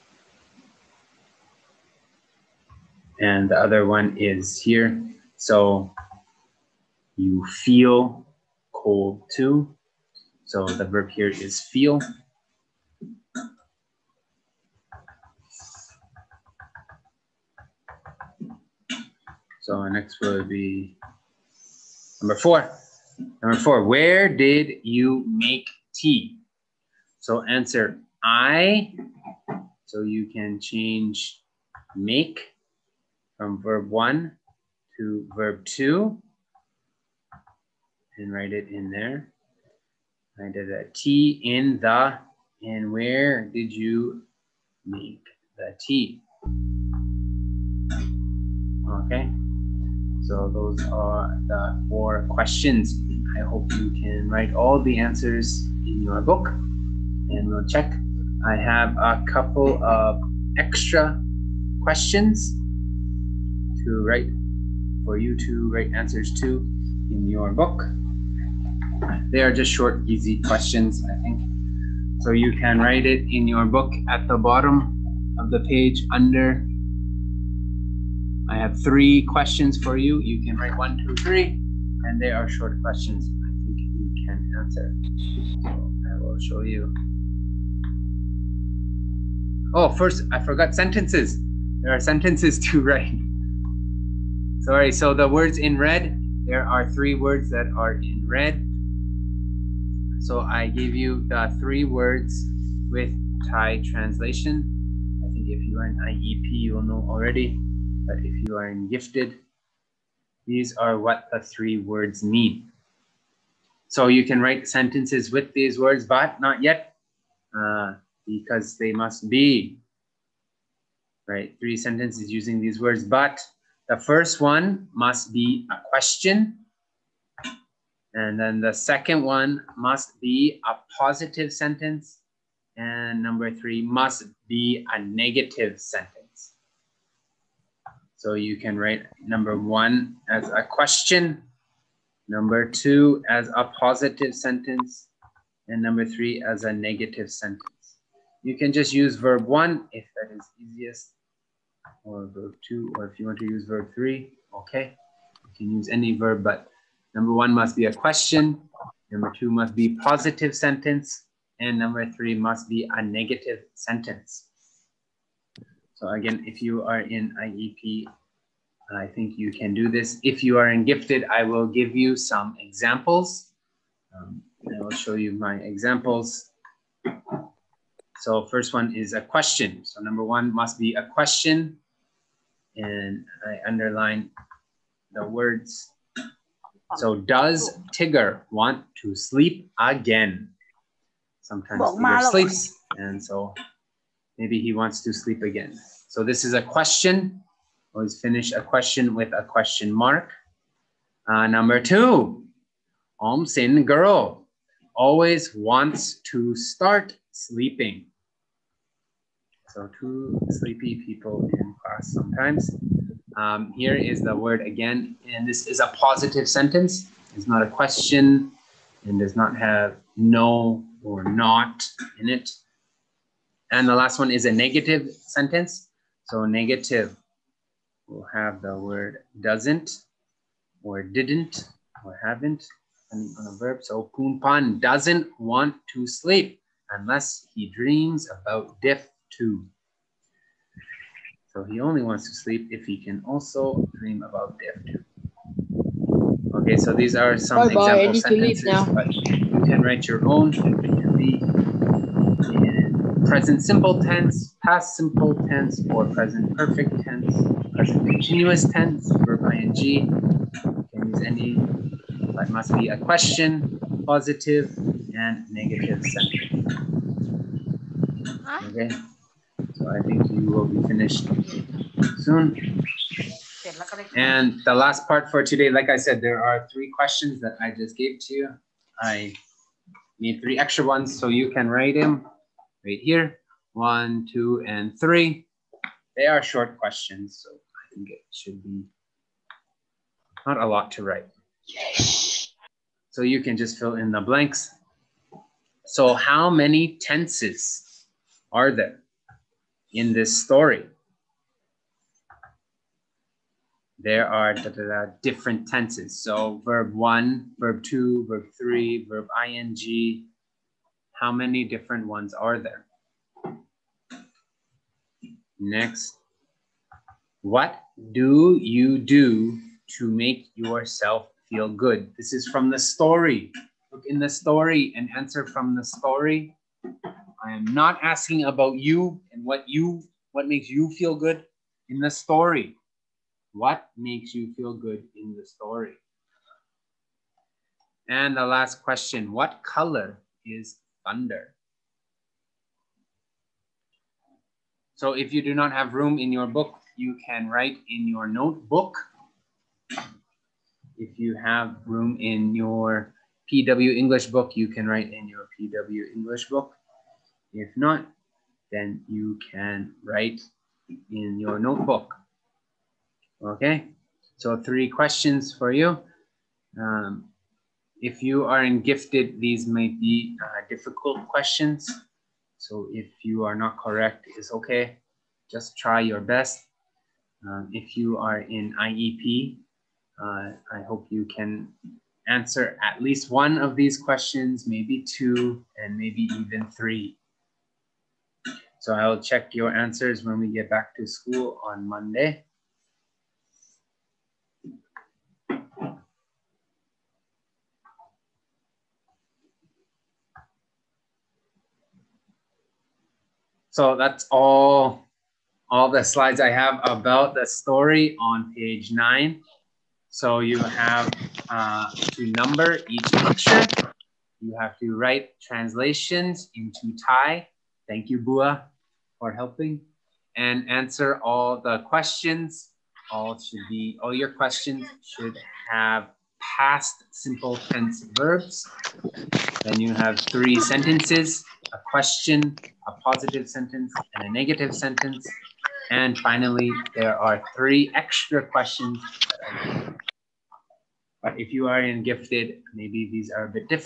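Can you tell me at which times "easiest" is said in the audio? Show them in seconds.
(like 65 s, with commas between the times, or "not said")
150 s.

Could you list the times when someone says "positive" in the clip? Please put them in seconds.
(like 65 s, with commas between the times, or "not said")
130 s, 143 s, 159 s, 215 s, 264 s, 433 s.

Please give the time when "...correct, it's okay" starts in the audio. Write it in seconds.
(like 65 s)
373 s.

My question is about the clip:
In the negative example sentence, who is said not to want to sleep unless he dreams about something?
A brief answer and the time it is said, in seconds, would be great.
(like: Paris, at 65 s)
Punpan, at 233 s.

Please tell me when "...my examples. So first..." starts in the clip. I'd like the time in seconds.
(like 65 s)
175 s.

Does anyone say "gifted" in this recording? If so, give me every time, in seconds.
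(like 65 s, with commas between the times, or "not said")
108 s, 170 s, 368 s, 442 s.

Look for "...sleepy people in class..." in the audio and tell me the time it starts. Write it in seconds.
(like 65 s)
210 s.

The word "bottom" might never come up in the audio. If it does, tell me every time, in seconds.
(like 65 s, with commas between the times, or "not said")
74 s.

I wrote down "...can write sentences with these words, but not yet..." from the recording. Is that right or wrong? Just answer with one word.
right.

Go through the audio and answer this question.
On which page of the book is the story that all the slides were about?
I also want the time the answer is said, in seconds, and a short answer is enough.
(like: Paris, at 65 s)
page 9, at 408 s.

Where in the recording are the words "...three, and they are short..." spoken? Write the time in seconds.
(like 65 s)
81 s.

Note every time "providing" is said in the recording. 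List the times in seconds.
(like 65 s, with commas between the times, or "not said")
not said.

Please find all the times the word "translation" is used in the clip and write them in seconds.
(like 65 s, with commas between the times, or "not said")
103 s, 415 s.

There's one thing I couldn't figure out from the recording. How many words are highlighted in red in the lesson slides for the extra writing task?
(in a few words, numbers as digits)
3.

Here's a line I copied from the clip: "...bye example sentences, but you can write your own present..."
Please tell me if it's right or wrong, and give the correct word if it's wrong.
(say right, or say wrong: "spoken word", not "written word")
right.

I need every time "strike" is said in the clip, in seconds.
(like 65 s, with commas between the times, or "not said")
not said.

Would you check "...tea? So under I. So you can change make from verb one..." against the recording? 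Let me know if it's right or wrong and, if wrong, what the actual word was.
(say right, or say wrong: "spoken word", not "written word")
wrong: "answer", not "under".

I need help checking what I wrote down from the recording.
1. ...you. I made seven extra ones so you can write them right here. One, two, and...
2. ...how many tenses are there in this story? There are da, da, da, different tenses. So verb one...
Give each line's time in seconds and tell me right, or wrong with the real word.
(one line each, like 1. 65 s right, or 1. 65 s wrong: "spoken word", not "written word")
1. 278 s wrong: "three", not "seven"
2. 296 s right.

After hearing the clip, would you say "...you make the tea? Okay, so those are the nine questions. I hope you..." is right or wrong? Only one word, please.
wrong.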